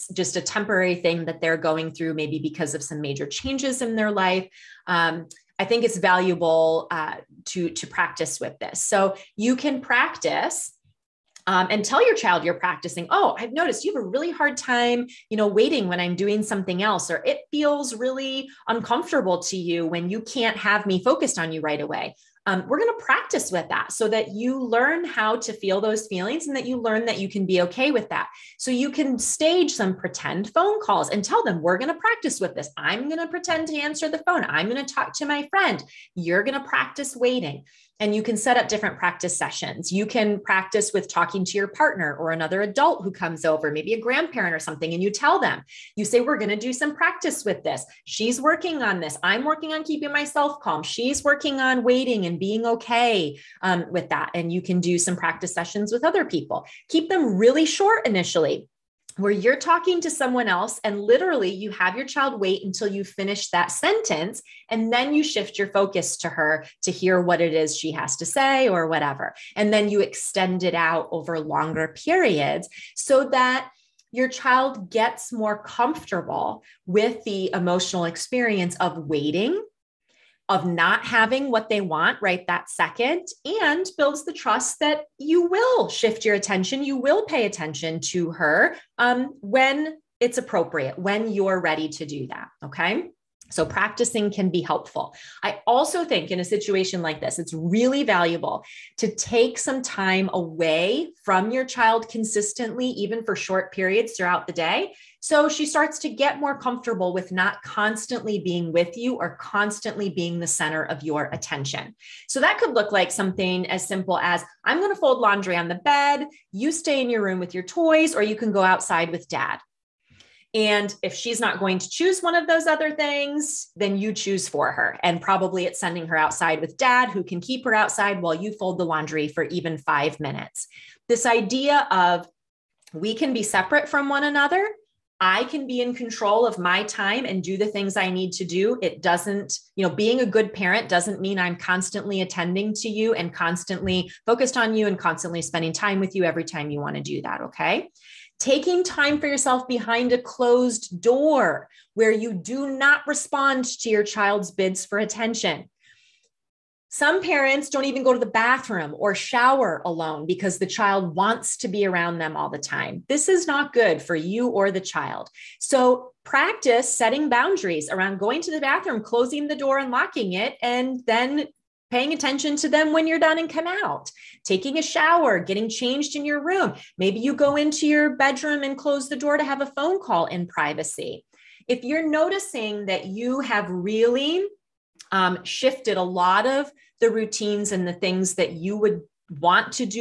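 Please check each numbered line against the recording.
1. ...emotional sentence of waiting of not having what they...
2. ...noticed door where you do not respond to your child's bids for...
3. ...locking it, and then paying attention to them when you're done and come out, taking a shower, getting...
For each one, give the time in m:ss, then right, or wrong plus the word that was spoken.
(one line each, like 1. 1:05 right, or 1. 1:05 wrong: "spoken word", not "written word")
1. 1:17 wrong: "experience", not "sentence"
2. 2:30 wrong: "closed", not "noticed"
3. 2:49 right.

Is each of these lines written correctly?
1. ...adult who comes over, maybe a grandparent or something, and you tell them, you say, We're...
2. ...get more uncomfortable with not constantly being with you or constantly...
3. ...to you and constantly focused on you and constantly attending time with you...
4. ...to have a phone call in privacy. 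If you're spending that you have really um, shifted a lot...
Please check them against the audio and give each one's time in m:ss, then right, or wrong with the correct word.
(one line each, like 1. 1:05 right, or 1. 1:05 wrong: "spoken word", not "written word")
1. 0:42 right
2. 1:46 wrong: "comfortable", not "uncomfortable"
3. 2:22 wrong: "spending", not "attending"
4. 2:59 wrong: "noticing", not "spending".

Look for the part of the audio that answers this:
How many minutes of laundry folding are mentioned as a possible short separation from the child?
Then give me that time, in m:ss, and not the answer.
2:09.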